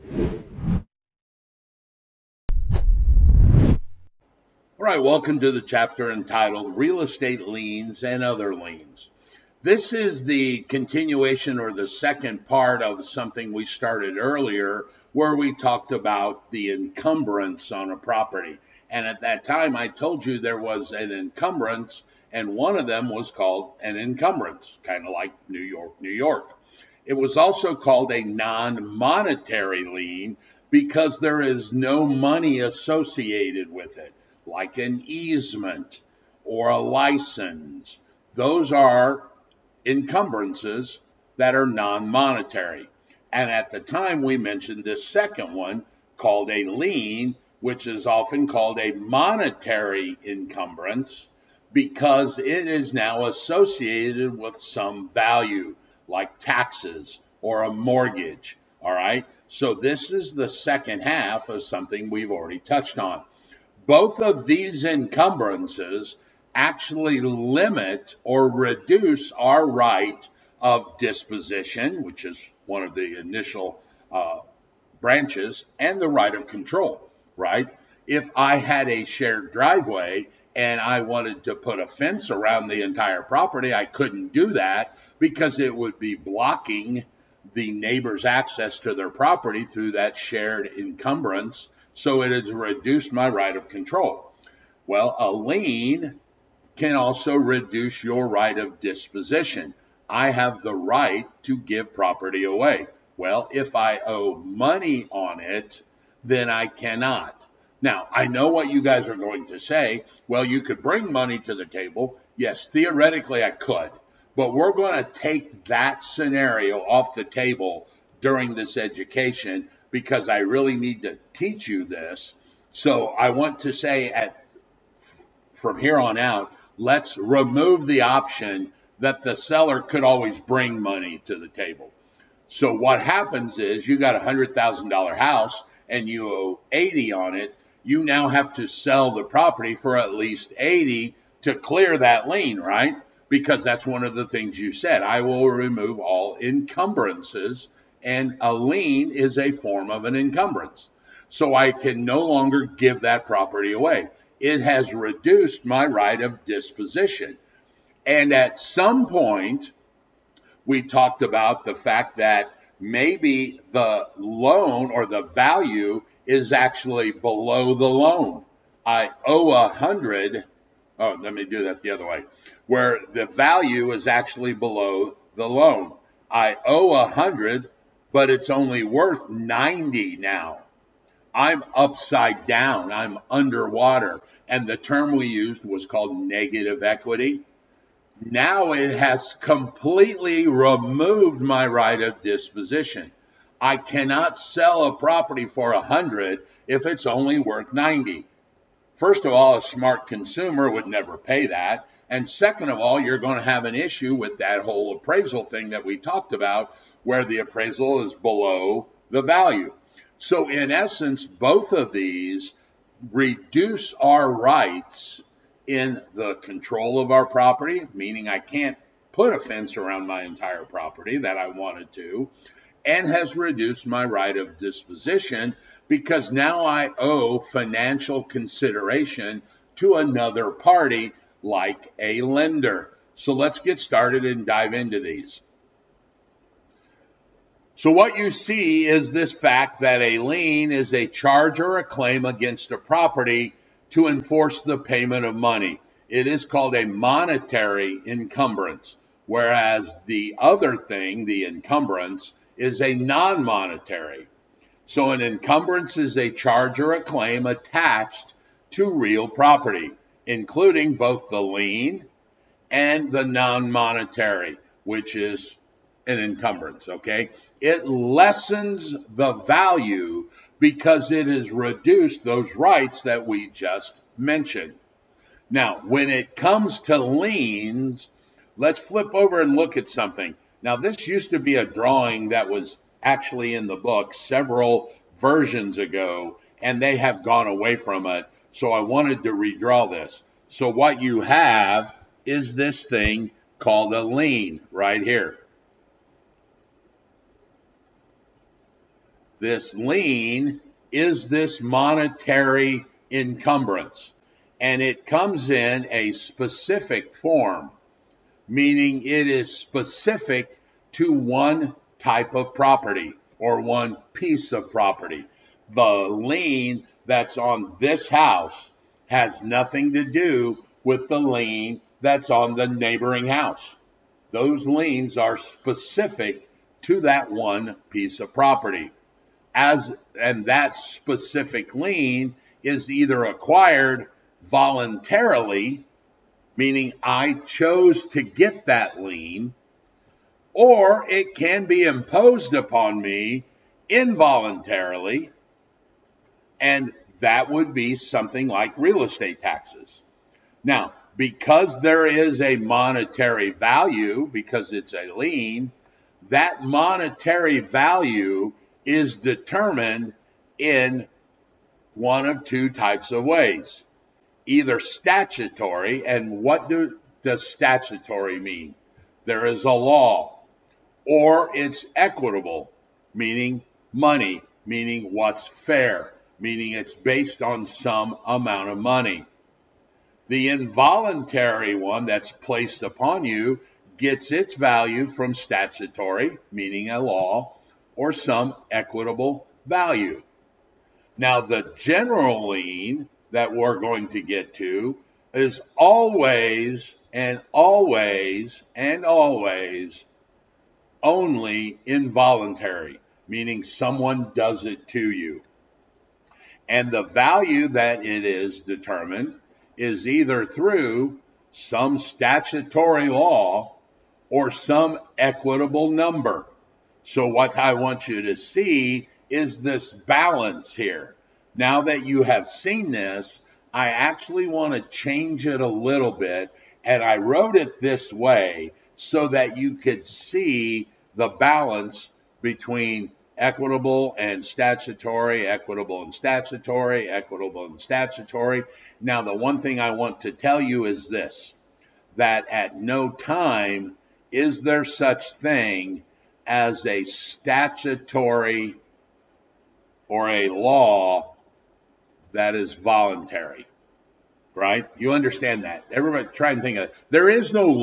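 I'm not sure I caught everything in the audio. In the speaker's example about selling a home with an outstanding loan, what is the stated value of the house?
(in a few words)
$100,000.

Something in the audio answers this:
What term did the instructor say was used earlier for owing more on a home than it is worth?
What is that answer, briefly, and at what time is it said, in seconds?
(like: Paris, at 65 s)
negative equity, at 186 s.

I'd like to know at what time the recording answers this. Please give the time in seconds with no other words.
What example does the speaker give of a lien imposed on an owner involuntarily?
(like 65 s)
348 s.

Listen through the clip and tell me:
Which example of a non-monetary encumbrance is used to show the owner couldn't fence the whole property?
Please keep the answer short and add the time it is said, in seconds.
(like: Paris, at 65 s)
shared driveway, at 79 s.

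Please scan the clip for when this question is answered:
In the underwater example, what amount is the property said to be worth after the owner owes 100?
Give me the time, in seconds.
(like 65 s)
178 s.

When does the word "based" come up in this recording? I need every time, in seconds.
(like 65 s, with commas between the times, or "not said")
376 s.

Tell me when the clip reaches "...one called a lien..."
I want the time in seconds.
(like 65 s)
45 s.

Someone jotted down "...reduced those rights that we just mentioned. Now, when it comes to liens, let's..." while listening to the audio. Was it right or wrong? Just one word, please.
right.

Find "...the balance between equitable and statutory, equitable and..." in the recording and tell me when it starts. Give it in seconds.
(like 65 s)
431 s.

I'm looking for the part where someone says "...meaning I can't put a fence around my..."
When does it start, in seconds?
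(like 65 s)
217 s.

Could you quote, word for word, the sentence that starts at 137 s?
You now have to sell the property for at least 80 to clear that lien, right?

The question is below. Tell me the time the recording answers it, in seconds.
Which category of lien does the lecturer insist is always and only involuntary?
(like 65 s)
391 s.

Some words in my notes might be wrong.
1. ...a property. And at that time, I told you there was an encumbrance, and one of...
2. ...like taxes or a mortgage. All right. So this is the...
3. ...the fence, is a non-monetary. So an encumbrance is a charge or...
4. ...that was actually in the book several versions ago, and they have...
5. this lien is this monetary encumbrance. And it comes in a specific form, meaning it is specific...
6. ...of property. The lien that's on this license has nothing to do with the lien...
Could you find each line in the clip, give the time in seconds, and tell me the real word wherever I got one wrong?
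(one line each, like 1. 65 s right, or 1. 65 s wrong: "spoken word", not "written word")
1. 17 s right
2. 56 s right
3. 251 s wrong: "encumbrance", not "fence"
4. 282 s right
5. 299 s right
6. 314 s wrong: "house", not "license".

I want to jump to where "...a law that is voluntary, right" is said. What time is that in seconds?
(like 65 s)
450 s.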